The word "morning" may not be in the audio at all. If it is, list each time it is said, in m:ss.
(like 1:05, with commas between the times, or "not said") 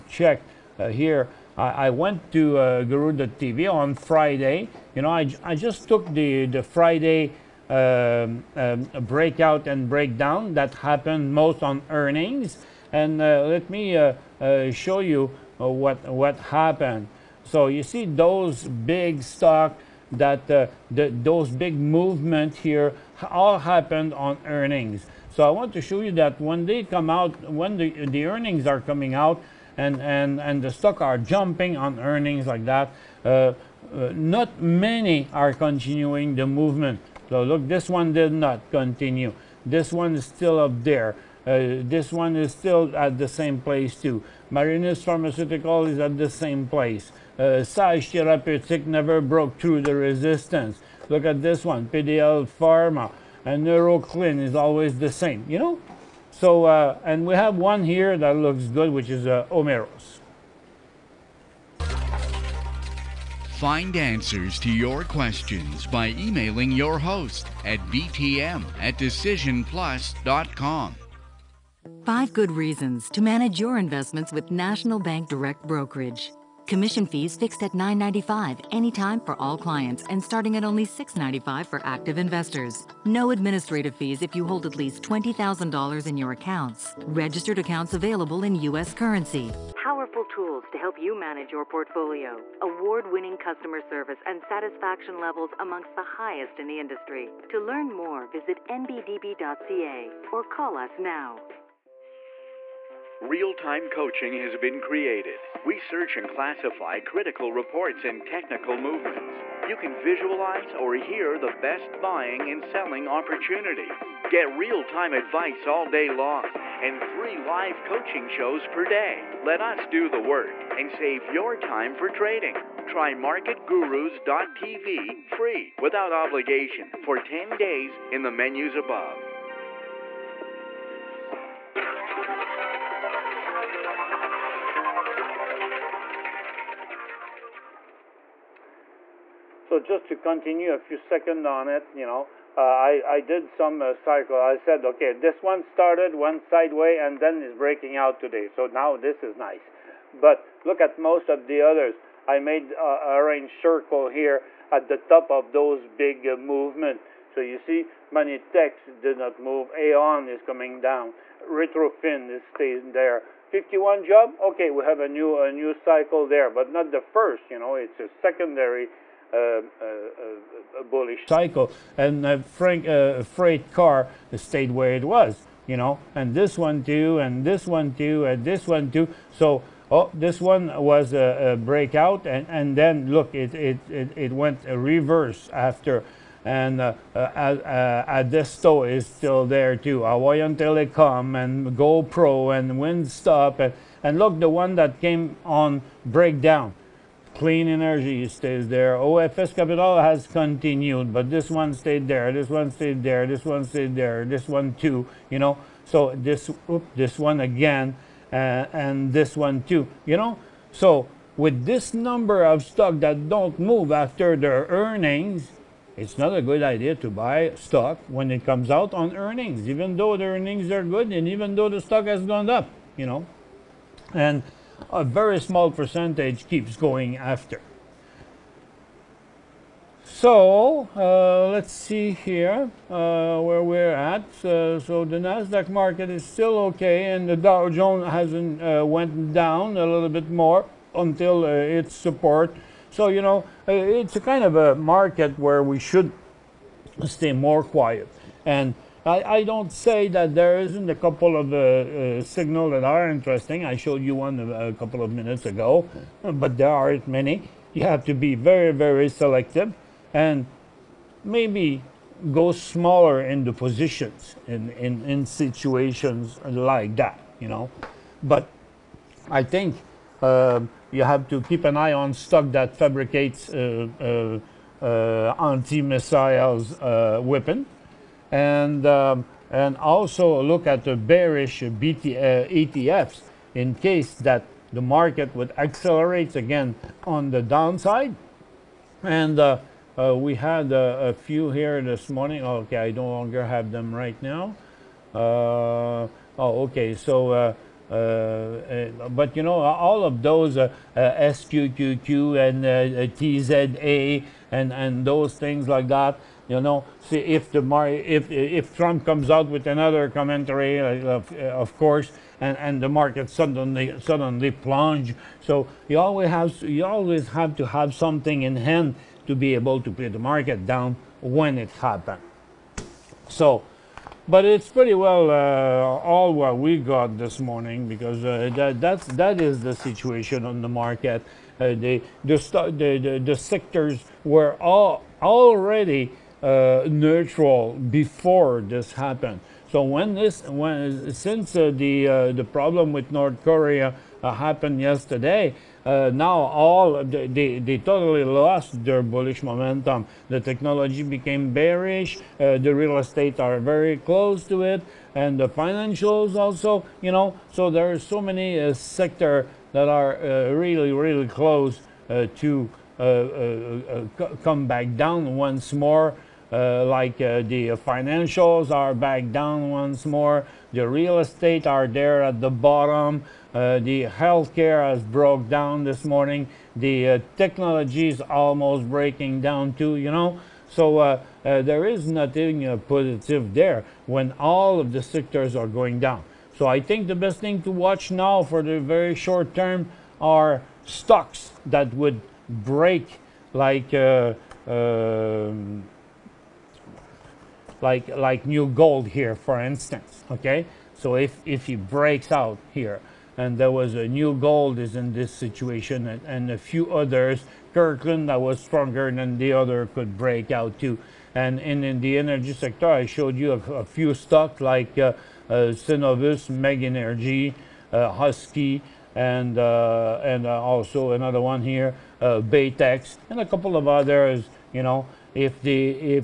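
4:52, 5:27, 6:16.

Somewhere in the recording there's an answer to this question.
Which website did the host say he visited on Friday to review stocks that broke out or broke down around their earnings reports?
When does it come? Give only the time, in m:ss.
0:02.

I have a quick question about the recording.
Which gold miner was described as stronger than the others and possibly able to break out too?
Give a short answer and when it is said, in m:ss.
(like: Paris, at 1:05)
Kirkland, at 6:47.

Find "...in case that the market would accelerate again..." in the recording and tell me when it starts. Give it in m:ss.
4:43.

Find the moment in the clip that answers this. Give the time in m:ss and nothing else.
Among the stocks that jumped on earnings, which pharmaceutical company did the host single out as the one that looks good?
0:59.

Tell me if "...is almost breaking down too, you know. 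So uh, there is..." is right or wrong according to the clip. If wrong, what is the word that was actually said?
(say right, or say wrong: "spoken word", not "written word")
right.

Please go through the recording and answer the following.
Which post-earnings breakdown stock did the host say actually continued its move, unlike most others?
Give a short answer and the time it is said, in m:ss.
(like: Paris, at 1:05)
OFS Capital, at 3:18.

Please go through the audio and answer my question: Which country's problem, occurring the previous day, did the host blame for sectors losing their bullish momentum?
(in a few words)
North Korea.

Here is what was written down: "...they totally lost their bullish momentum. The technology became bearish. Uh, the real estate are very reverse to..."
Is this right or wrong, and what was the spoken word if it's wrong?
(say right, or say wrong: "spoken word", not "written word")
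wrong: "close", not "reverse".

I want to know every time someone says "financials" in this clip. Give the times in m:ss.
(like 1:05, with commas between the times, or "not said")
5:55, 6:07.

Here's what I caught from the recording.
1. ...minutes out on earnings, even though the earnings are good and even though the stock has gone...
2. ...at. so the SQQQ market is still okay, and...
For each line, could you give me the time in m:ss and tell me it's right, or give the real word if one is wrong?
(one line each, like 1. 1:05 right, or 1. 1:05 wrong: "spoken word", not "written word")
1. 3:38 wrong: "comes", not "minutes"
2. 3:53 wrong: "Nasdaq", not "SQQQ".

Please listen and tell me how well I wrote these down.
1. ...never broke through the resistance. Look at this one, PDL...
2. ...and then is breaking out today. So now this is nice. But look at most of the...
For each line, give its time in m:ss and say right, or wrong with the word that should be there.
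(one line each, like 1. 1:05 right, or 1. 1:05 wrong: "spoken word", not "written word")
1. 0:48 right
2. 2:26 right.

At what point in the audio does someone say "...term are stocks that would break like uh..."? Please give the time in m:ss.
6:29.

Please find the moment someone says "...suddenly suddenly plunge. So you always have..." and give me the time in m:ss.
5:13.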